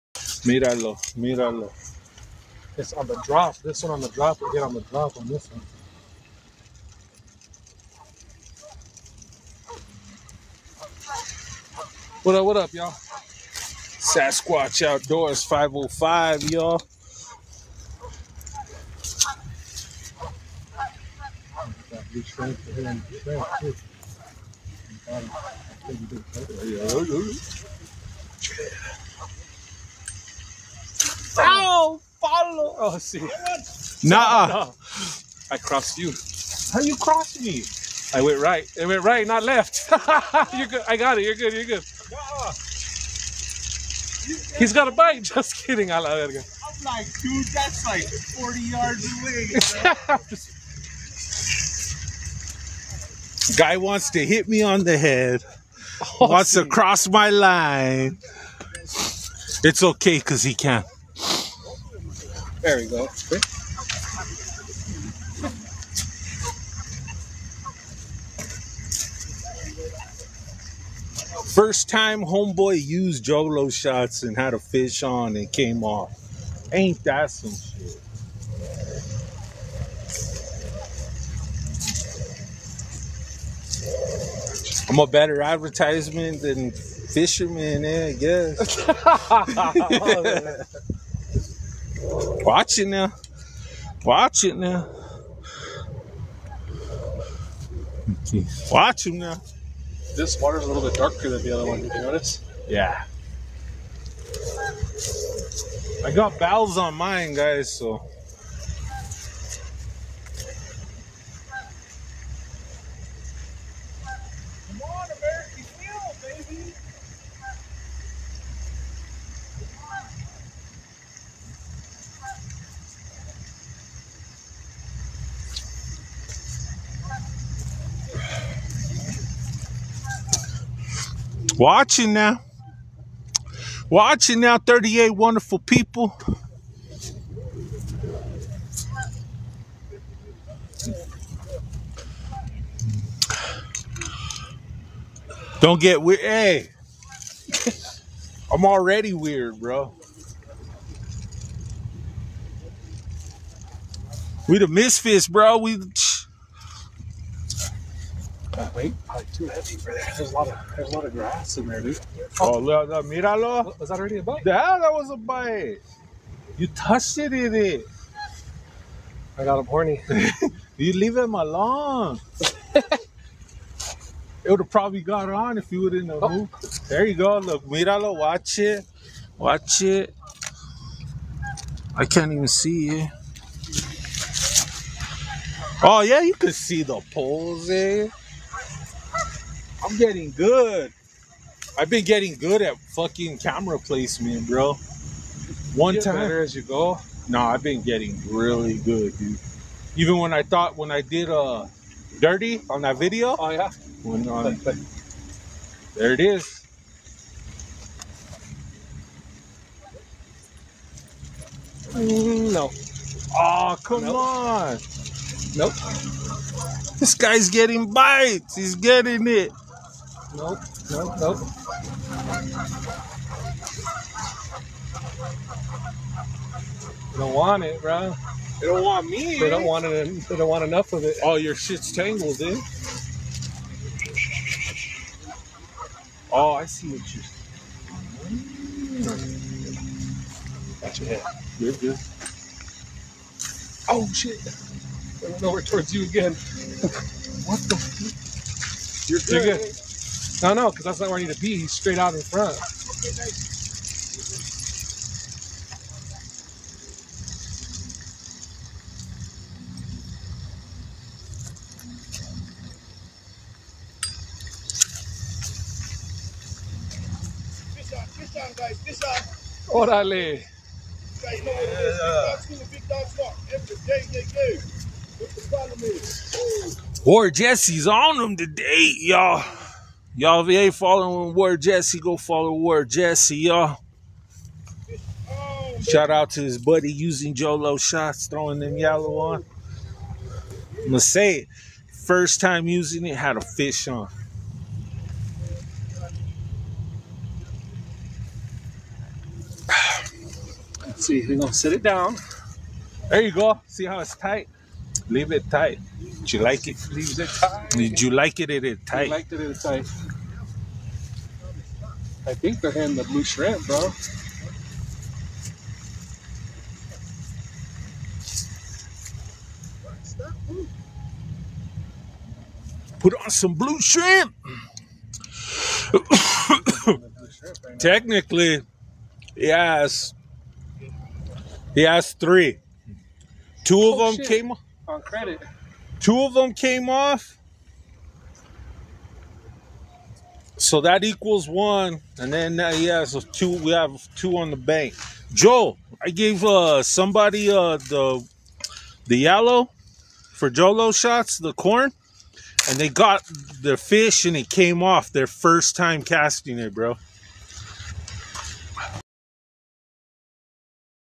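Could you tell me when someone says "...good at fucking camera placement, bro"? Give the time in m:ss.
3:12.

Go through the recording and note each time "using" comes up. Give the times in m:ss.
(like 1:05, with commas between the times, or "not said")
4:46, 4:52.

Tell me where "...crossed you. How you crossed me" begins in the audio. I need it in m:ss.
0:35.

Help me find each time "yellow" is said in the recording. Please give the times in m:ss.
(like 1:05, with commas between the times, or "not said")
4:48, 5:49.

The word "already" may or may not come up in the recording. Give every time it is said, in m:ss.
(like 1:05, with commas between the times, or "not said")
2:28, 2:43.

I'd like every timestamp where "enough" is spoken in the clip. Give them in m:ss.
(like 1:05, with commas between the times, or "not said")
3:50.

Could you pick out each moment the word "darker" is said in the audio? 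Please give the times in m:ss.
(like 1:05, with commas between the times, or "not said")
1:40.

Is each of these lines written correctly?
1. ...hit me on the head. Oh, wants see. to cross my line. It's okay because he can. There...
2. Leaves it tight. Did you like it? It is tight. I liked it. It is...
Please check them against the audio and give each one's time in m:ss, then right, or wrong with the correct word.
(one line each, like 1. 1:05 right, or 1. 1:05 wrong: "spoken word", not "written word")
1. 0:54 right
2. 5:06 right.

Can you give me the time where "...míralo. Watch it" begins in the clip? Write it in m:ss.
2:57.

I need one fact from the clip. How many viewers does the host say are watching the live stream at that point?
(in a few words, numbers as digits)
38.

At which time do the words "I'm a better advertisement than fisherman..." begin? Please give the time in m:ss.
1:24.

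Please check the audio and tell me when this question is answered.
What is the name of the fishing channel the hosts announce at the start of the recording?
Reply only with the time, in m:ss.
0:12.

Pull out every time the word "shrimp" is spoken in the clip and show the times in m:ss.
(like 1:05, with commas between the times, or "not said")
5:13, 5:23.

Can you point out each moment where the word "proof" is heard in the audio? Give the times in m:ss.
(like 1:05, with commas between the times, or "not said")
not said.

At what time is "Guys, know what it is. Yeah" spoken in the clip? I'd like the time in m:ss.
4:31.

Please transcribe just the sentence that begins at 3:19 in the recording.
Even when I thought when I did uh dirty on that video.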